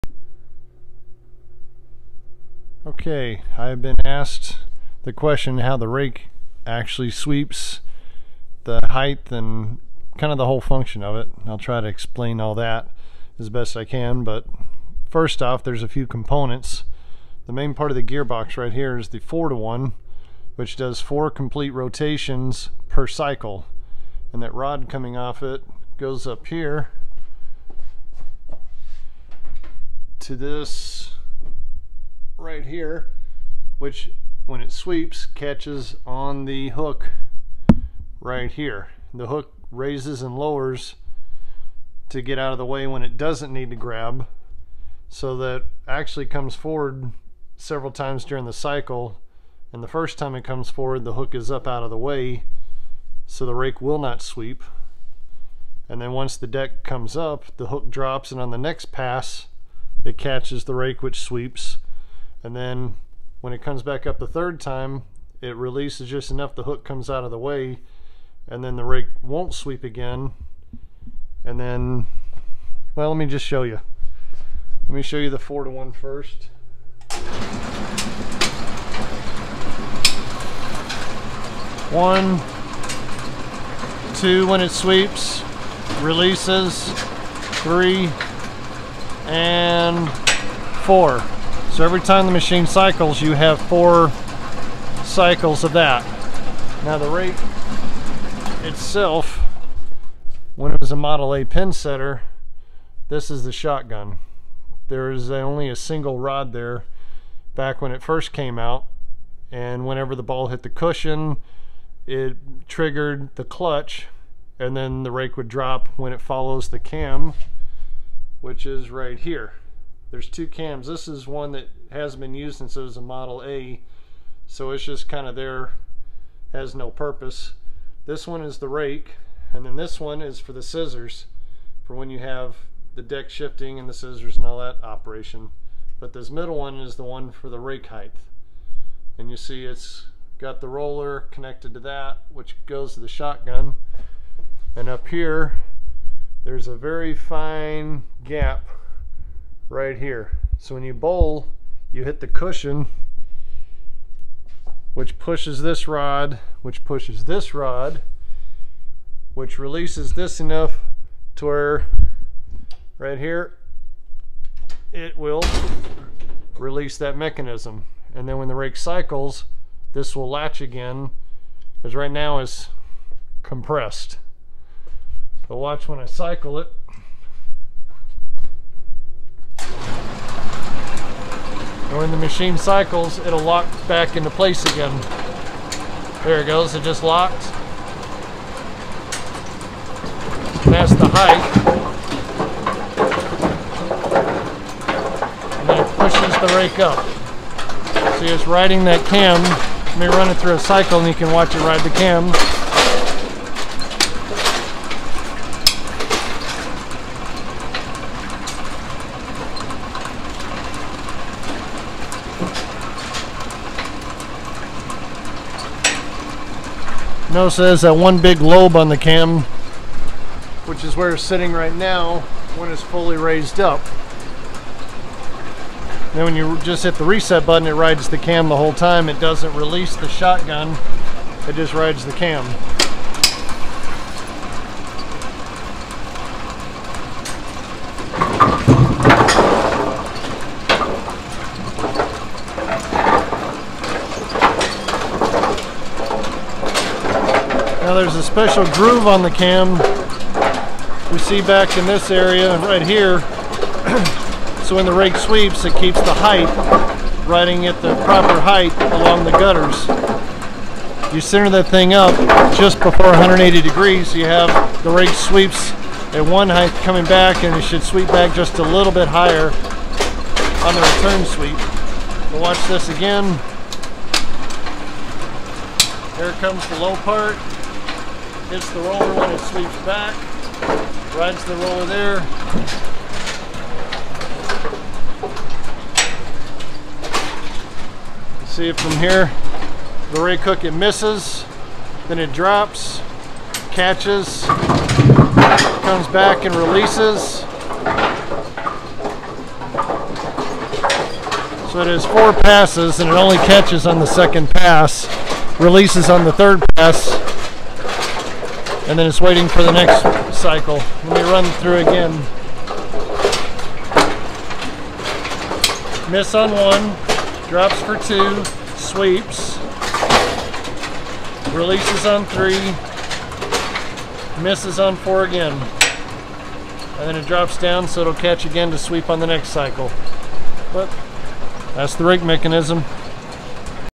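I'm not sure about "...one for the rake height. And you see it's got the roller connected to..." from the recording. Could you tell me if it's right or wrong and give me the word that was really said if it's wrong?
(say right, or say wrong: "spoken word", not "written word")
right.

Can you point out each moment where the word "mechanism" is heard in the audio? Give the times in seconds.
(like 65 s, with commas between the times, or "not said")
167 s, 332 s.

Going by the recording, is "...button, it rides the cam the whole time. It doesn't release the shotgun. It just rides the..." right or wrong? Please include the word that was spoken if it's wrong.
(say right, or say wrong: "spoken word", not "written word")
right.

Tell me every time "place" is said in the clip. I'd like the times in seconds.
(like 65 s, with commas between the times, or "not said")
184 s.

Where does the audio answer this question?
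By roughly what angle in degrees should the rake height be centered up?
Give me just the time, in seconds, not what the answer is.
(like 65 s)
263 s.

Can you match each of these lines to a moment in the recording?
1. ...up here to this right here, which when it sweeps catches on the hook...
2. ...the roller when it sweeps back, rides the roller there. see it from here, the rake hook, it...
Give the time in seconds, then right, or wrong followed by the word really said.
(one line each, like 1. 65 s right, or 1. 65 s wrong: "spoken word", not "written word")
1. 26 s right
2. 278 s right.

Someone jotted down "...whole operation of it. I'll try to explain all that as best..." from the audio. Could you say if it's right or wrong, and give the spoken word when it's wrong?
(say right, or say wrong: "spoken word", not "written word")
wrong: "function", not "operation".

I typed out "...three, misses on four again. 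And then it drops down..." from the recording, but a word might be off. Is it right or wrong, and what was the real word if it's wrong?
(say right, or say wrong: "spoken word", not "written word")
right.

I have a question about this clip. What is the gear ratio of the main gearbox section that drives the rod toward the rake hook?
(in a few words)
4 to 1.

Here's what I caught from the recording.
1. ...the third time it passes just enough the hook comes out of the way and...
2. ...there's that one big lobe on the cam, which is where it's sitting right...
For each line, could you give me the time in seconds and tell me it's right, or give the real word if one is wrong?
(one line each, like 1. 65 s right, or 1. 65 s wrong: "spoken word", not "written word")
1. 64 s wrong: "releases", not "passes"
2. 217 s right.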